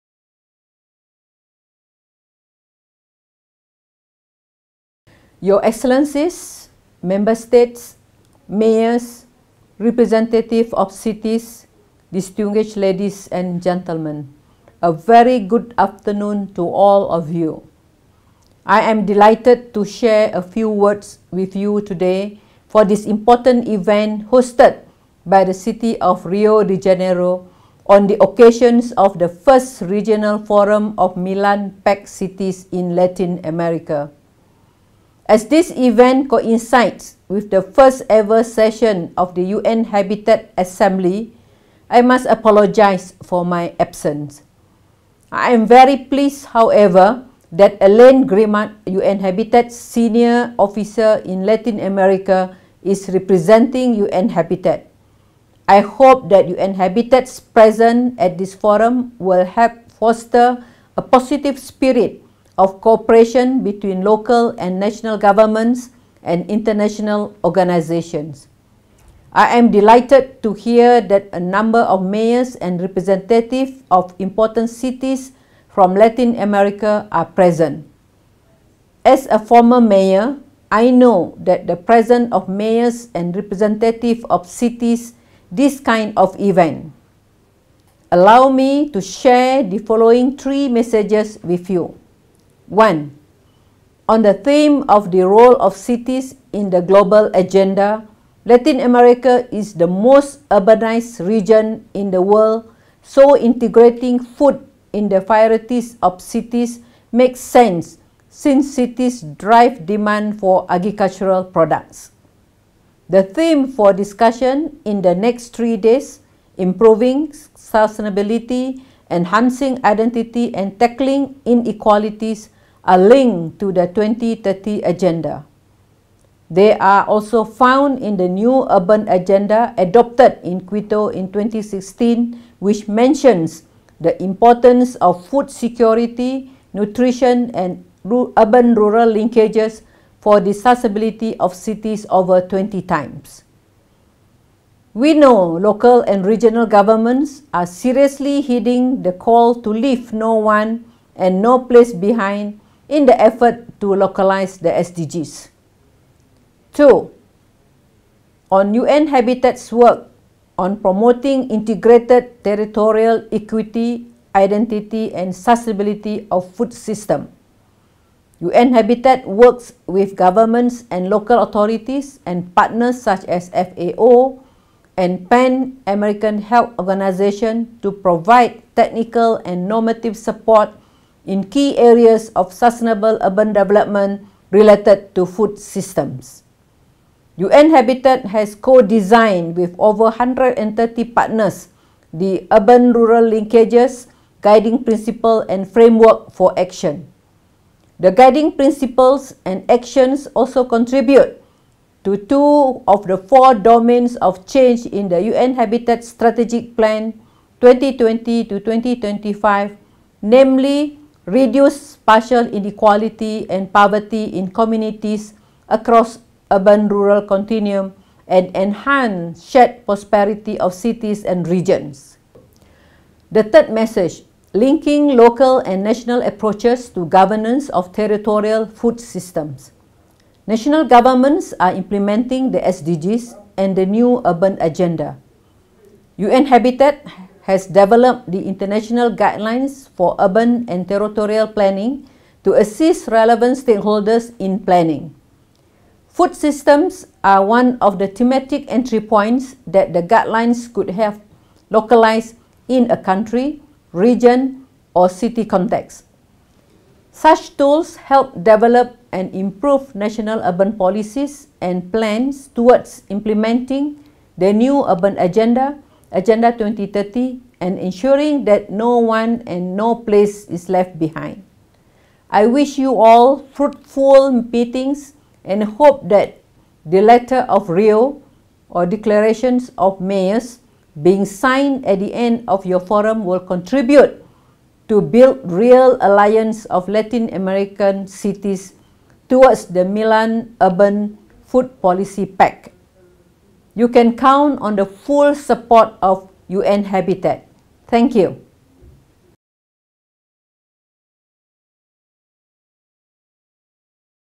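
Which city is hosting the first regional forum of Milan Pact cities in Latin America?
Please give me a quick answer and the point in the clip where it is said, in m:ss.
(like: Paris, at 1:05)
Rio de Janeiro, at 0:26.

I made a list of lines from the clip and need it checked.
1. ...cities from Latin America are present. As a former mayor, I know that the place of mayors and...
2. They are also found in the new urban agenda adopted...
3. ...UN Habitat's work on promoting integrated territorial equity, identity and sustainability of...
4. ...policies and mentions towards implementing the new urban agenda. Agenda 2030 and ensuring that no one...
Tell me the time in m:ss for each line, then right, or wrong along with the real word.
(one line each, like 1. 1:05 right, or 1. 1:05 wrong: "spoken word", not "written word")
1. 1:14 wrong: "presence", not "place"
2. 2:06 right
3. 2:38 right
4. 4:20 wrong: "plans", not "mentions".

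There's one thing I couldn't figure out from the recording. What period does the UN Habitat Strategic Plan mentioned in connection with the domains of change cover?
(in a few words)
2020 to 2025.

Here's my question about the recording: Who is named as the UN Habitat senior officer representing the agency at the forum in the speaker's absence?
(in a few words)
Elaine Grimard.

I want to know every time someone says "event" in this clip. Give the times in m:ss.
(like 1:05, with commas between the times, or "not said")
0:23, 0:35, 1:26.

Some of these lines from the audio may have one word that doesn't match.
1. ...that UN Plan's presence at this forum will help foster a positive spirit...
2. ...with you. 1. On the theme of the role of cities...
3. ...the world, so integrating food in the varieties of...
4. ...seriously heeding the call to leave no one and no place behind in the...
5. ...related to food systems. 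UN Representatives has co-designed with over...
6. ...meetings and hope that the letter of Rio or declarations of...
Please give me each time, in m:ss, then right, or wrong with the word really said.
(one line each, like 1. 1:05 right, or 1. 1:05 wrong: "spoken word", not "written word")
1. 0:56 wrong: "Habitat", not "Plan"
2. 1:31 right
3. 1:42 right
4. 2:27 right
5. 3:04 wrong: "Habitat", not "Representatives"
6. 4:34 right.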